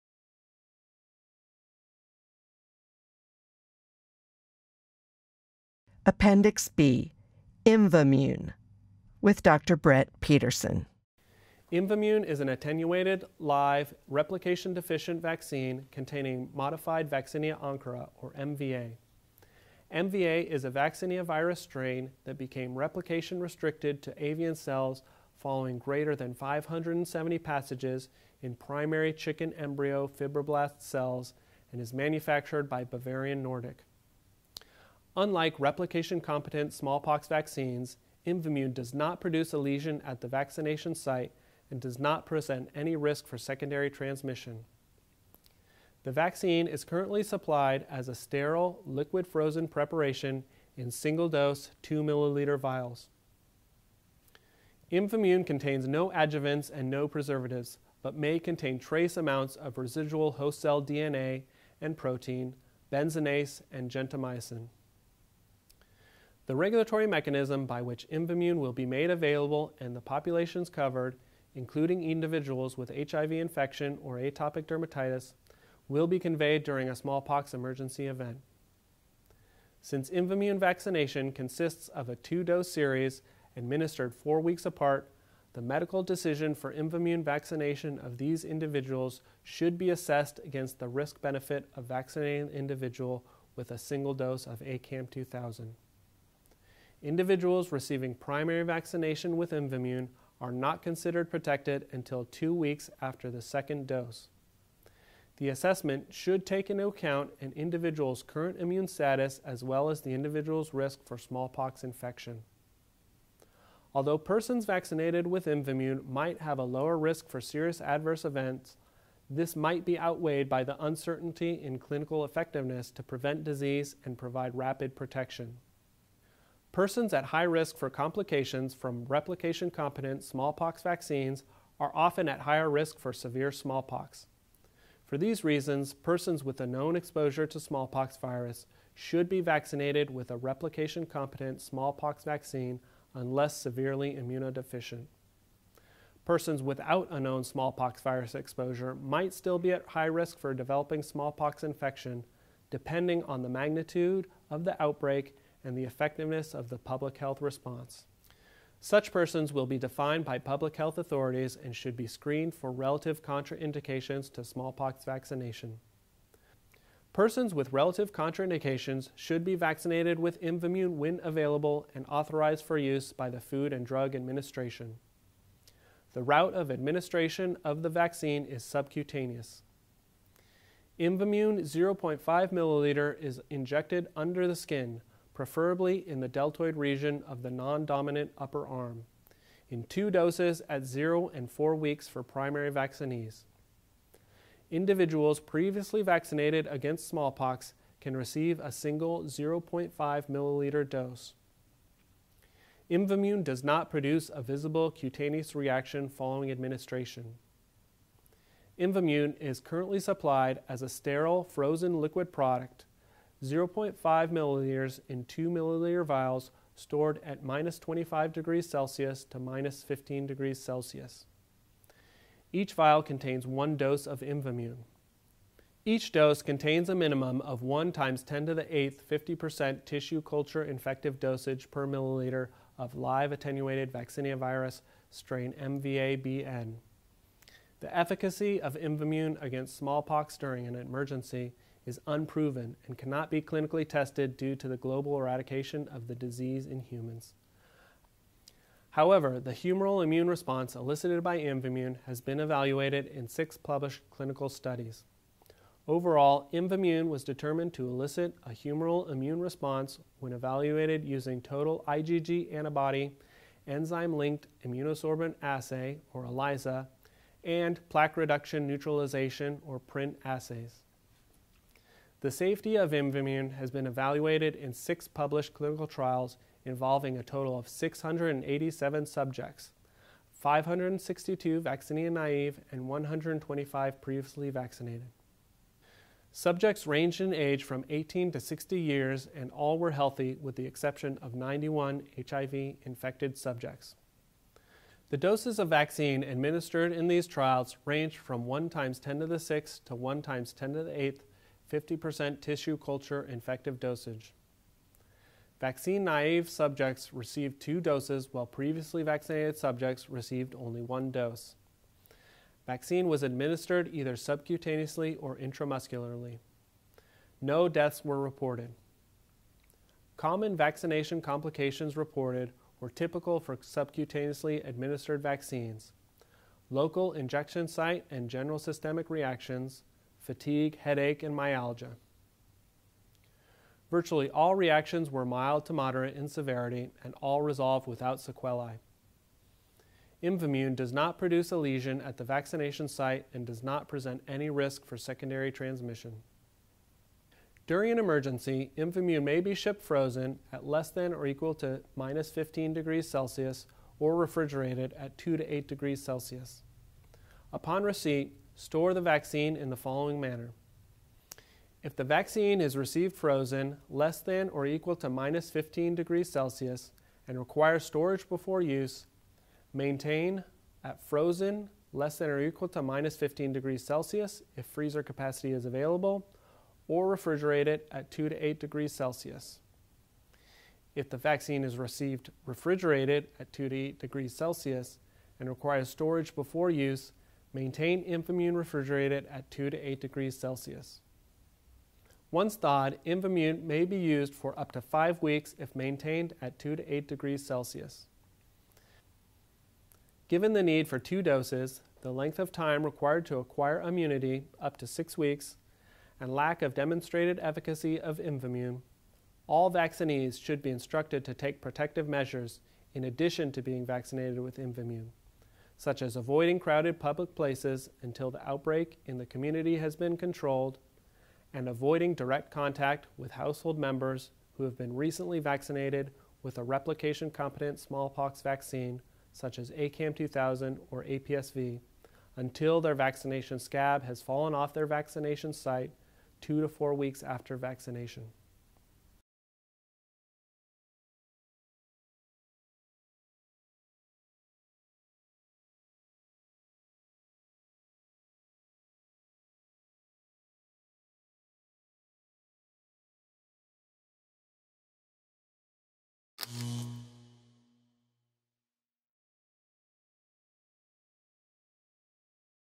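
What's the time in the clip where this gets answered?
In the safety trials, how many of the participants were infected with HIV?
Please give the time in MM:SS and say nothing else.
04:51.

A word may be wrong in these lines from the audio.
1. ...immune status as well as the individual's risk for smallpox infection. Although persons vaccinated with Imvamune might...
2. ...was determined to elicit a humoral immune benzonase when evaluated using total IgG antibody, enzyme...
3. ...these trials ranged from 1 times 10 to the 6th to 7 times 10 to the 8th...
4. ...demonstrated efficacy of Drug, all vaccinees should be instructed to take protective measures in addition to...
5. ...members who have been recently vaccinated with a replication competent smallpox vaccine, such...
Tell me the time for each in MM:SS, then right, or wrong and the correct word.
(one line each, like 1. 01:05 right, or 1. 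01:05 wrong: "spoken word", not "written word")
1. 01:48 right
2. 04:17 wrong: "response", not "benzonase"
3. 04:57 wrong: "1", not "7"
4. 06:46 wrong: "Imvamune", not "Drug"
5. 07:03 right.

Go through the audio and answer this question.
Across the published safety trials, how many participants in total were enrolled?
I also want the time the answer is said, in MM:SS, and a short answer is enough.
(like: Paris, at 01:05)
687, at 04:37.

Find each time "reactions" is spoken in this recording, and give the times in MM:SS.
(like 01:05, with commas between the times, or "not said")
03:25, 05:29, 05:34.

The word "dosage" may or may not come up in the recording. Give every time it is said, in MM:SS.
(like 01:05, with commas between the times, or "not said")
03:51, 05:03.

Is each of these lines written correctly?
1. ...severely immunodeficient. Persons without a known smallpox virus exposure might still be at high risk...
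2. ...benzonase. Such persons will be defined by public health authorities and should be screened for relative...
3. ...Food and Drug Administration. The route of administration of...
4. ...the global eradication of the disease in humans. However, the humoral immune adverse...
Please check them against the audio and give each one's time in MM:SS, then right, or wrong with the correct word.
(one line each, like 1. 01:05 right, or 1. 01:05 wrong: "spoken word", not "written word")
1. 02:23 right
2. 02:37 wrong: "response", not "benzonase"
3. 02:53 right
4. 04:04 wrong: "response", not "adverse".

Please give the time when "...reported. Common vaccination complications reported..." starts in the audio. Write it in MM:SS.
05:18.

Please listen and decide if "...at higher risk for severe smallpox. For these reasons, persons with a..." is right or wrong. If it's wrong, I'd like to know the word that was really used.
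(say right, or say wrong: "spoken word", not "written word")
right.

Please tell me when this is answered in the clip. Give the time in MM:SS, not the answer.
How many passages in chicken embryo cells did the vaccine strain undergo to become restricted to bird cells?
00:25.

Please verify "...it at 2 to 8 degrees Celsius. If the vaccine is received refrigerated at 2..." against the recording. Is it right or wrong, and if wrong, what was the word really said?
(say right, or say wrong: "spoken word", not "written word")
right.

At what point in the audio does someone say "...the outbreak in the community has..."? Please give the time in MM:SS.
06:58.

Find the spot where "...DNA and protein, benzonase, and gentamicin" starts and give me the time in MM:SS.
01:00.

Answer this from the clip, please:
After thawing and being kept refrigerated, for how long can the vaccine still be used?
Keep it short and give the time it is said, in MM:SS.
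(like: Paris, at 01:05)
up to 5 weeks, at 06:34.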